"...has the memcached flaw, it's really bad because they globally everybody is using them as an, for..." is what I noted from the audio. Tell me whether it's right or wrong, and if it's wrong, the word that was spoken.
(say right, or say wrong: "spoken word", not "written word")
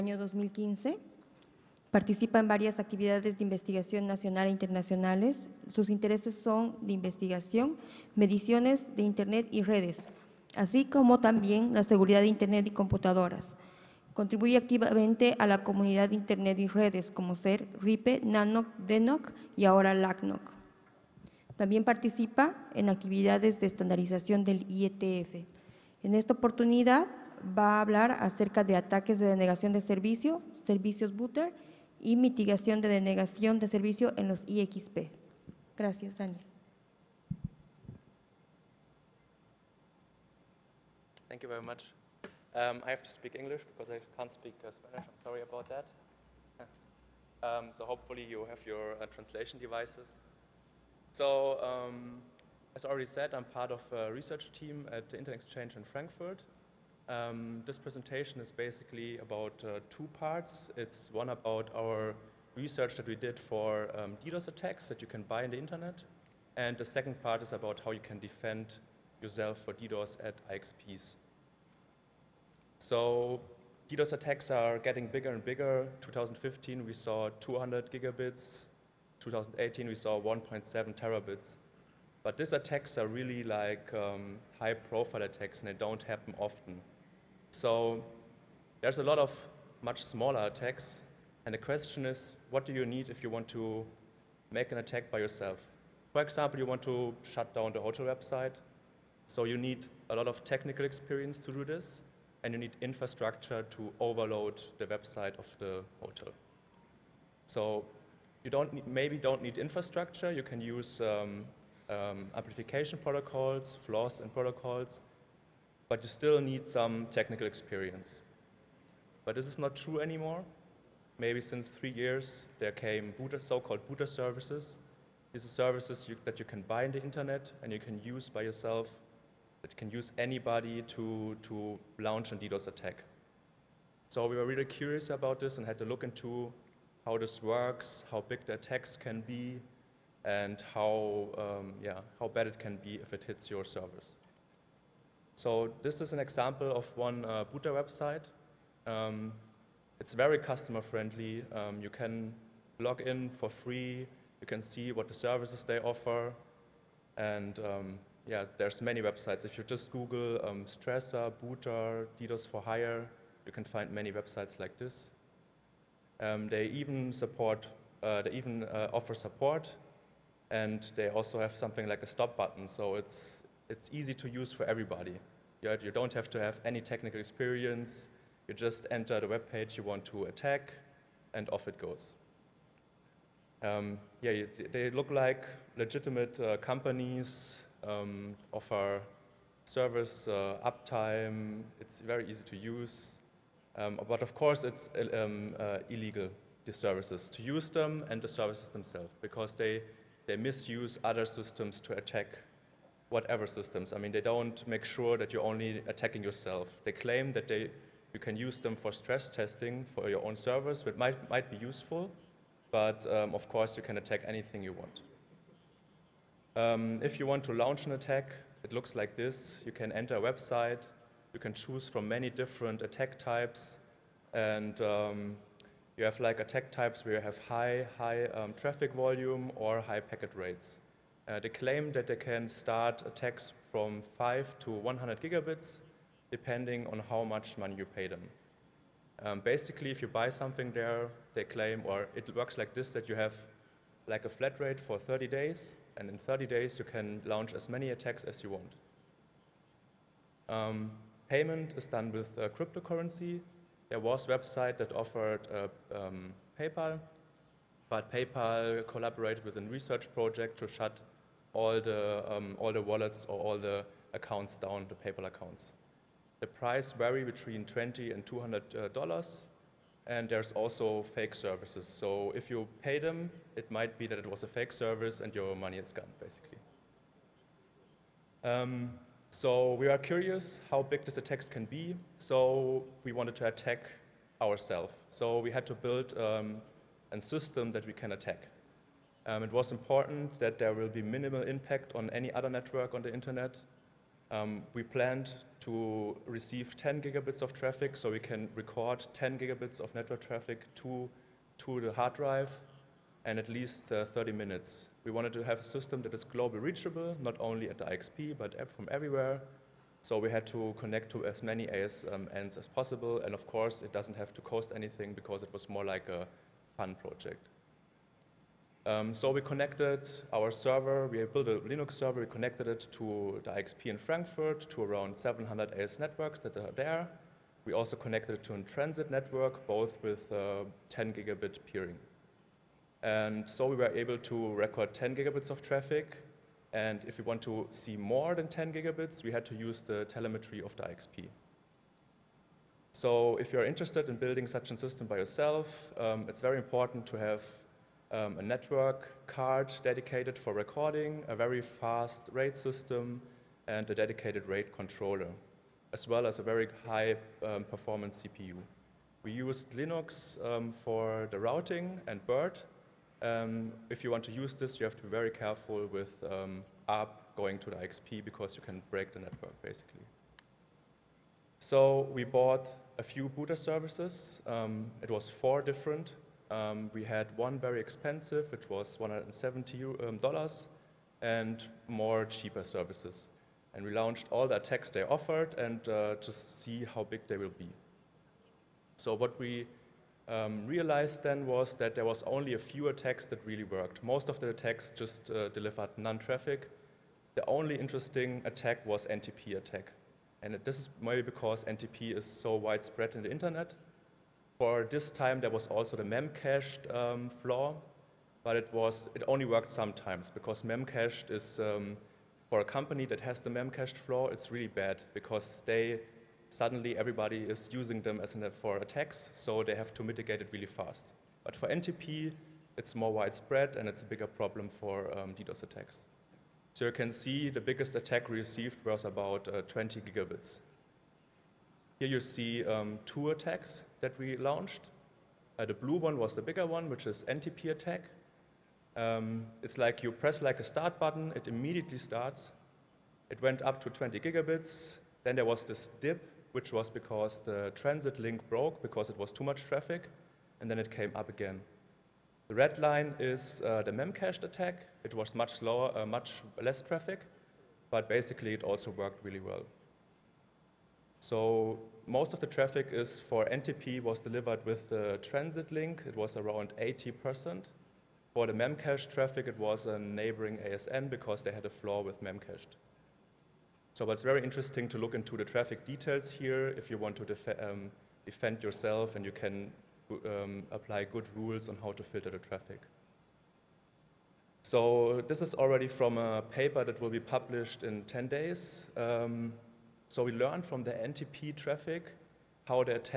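wrong: "suddenly", not "globally".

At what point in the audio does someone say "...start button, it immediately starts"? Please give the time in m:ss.
7:20.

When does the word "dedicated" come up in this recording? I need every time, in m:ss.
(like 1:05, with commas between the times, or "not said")
5:49, 5:53.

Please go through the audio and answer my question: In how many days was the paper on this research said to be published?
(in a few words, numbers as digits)
10 days.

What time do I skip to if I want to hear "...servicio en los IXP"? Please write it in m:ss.
0:33.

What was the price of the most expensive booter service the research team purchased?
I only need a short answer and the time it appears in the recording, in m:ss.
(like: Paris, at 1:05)
$170, at 6:18.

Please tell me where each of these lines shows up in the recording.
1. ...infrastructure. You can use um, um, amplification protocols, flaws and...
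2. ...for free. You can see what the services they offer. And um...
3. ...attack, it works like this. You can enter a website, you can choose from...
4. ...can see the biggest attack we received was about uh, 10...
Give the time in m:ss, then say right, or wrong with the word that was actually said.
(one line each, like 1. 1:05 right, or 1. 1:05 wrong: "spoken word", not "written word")
1. 1:49 right
2. 2:33 right
3. 3:37 wrong: "looks", not "works"
4. 7:06 wrong: "20", not "10".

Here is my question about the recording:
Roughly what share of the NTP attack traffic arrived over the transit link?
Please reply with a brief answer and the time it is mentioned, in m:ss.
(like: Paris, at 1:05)
80%, at 7:46.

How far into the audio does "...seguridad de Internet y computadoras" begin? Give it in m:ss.
0:11.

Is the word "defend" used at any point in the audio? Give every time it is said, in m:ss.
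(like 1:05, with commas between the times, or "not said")
1:08, 7:58.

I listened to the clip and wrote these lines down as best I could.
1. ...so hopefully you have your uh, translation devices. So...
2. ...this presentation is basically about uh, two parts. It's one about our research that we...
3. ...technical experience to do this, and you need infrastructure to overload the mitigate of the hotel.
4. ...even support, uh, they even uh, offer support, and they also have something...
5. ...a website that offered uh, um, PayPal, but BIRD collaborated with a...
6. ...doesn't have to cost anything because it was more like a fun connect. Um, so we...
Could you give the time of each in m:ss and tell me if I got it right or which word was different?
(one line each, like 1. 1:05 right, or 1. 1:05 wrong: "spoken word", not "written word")
1. 0:47 right
2. 0:57 right
3. 1:40 wrong: "website", not "mitigate"
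4. 2:46 right
5. 4:14 wrong: "PayPal", not "BIRD"
6. 5:13 wrong: "project", not "connect".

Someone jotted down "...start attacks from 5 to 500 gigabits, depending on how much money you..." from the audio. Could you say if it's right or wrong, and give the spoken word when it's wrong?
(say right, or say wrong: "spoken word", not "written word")
wrong: "100", not "500".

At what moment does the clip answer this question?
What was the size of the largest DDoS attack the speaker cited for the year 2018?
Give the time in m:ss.
1:20.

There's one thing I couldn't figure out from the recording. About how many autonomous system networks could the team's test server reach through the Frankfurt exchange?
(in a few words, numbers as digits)
700.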